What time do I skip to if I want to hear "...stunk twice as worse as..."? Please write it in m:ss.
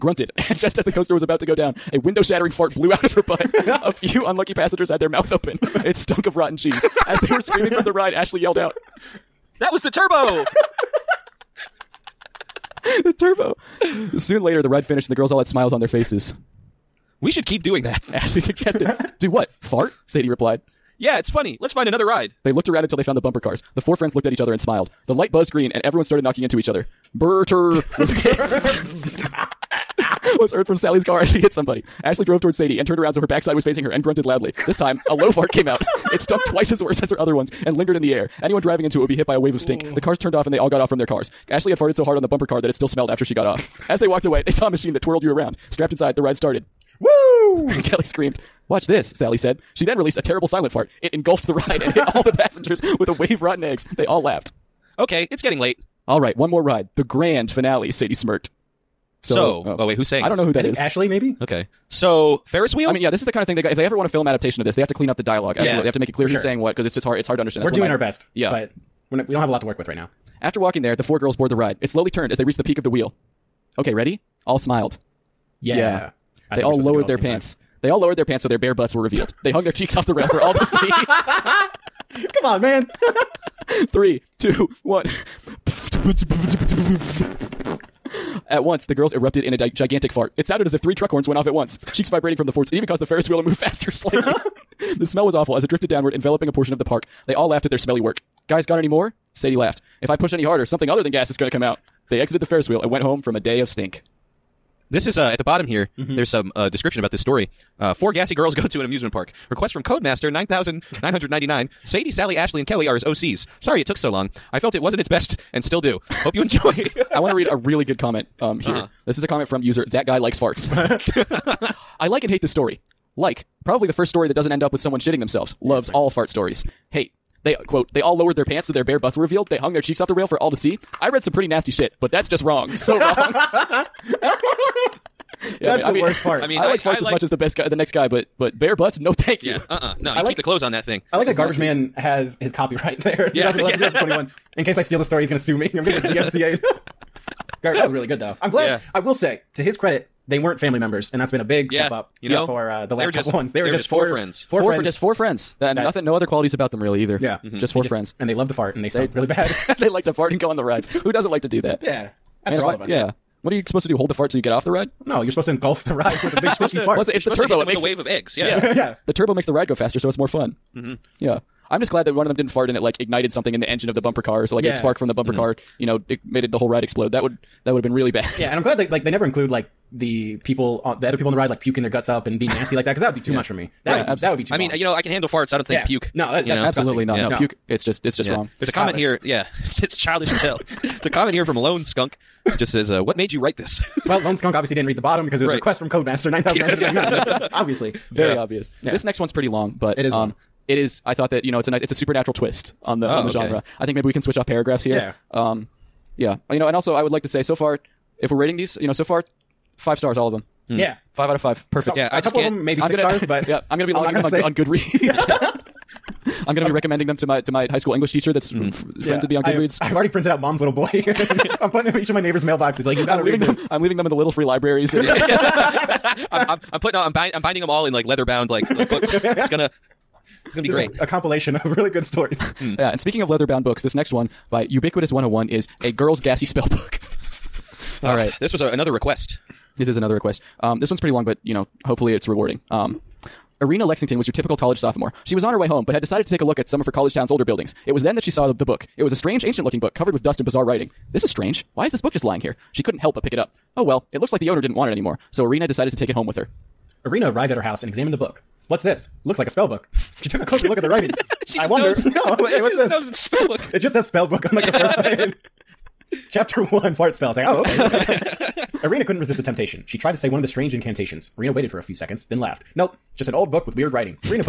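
0:36.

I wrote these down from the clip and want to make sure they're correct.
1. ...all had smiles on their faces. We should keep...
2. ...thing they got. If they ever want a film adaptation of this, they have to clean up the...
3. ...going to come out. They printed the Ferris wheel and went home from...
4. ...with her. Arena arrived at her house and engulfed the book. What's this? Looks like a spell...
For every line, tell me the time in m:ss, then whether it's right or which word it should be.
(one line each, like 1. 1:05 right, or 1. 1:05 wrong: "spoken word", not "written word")
1. 0:15 right
2. 1:03 right
3. 1:41 wrong: "exited", not "printed"
4. 4:16 wrong: "examined", not "engulfed".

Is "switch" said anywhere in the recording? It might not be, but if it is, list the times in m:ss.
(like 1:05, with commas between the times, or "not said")
3:24.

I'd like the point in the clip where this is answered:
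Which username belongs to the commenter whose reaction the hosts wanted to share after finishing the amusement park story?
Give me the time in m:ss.
1:59.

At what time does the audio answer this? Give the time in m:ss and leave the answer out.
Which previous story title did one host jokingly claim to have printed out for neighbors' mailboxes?
3:40.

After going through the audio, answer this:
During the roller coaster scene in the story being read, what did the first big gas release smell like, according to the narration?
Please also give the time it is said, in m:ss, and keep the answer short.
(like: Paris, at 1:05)
rotten cheese, at 0:06.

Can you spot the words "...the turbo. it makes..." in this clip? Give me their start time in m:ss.
2:47.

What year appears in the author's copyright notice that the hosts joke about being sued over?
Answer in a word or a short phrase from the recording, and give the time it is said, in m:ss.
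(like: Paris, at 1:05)
2021, at 2:23.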